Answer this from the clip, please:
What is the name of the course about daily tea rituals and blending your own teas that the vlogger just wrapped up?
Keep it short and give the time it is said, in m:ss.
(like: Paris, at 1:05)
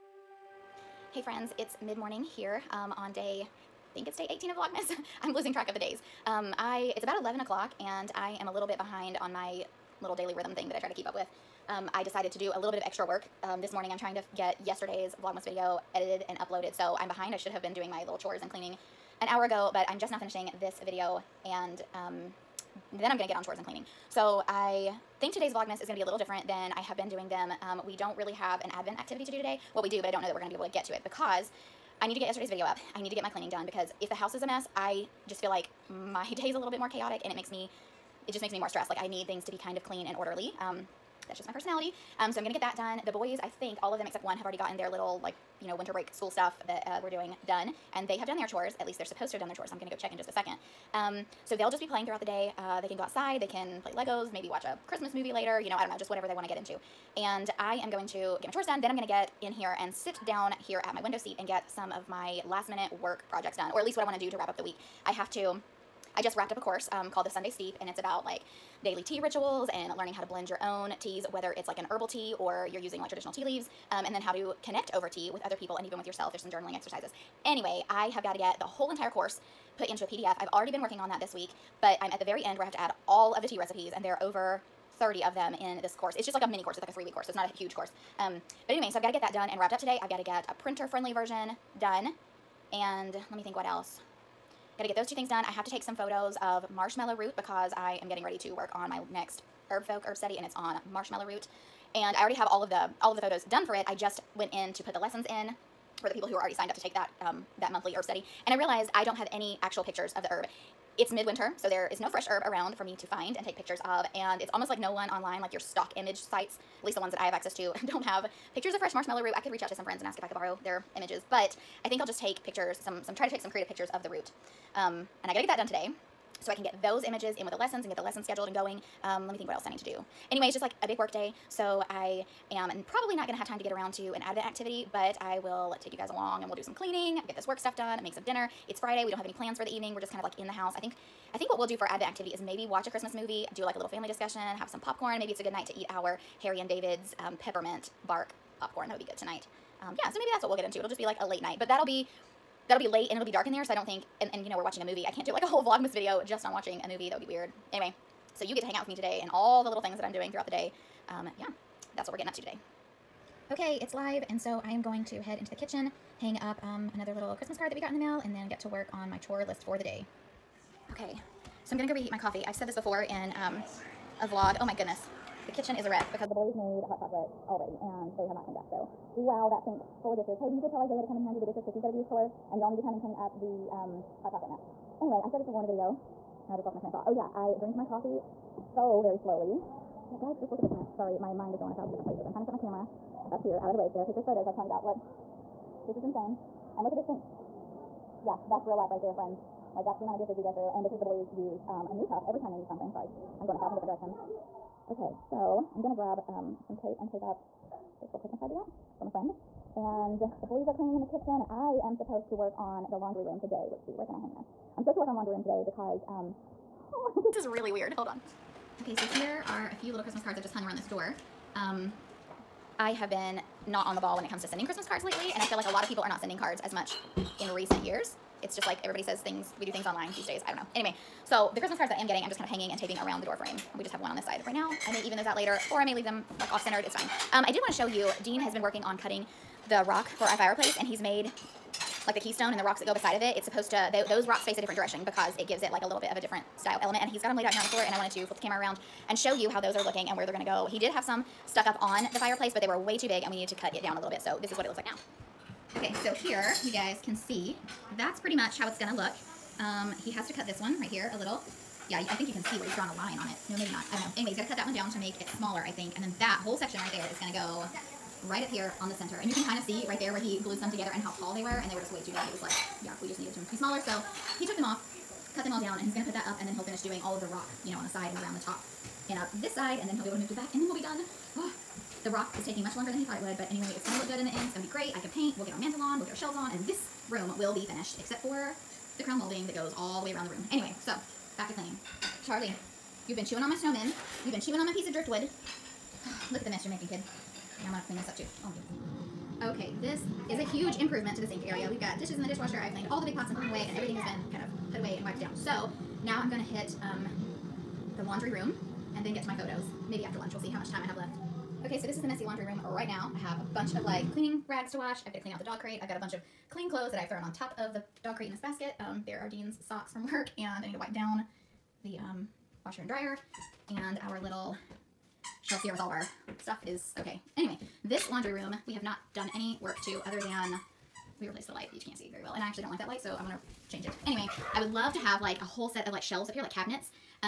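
Sunday Steep, at 1:07.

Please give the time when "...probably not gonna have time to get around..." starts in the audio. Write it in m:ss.
2:12.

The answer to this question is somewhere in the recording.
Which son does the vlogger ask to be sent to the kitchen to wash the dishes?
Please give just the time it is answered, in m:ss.
3:00.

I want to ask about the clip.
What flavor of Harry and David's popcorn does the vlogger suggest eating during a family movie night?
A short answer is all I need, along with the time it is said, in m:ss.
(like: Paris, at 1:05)
peppermint bark, at 2:27.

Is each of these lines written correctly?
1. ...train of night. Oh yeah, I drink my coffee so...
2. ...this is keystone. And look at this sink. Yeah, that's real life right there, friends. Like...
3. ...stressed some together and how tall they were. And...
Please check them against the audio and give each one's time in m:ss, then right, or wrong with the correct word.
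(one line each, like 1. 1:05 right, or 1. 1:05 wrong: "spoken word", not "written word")
1. 3:06 wrong: "thought", not "night"
2. 3:15 wrong: "insane", not "keystone"
3. 4:30 wrong: "glued", not "stressed".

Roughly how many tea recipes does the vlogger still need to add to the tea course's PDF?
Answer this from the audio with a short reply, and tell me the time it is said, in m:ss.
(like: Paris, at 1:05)
over 30, at 1:24.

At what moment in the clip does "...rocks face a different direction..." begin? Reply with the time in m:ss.
4:04.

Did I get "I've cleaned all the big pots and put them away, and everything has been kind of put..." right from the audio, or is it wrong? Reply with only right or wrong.
right.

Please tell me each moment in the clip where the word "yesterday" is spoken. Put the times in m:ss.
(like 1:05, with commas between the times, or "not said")
0:14, 0:32.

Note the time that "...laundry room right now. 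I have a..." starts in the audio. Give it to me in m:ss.
5:12.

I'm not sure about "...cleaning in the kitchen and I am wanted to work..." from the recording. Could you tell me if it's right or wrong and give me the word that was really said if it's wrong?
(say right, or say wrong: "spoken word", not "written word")
wrong: "supposed", not "wanted".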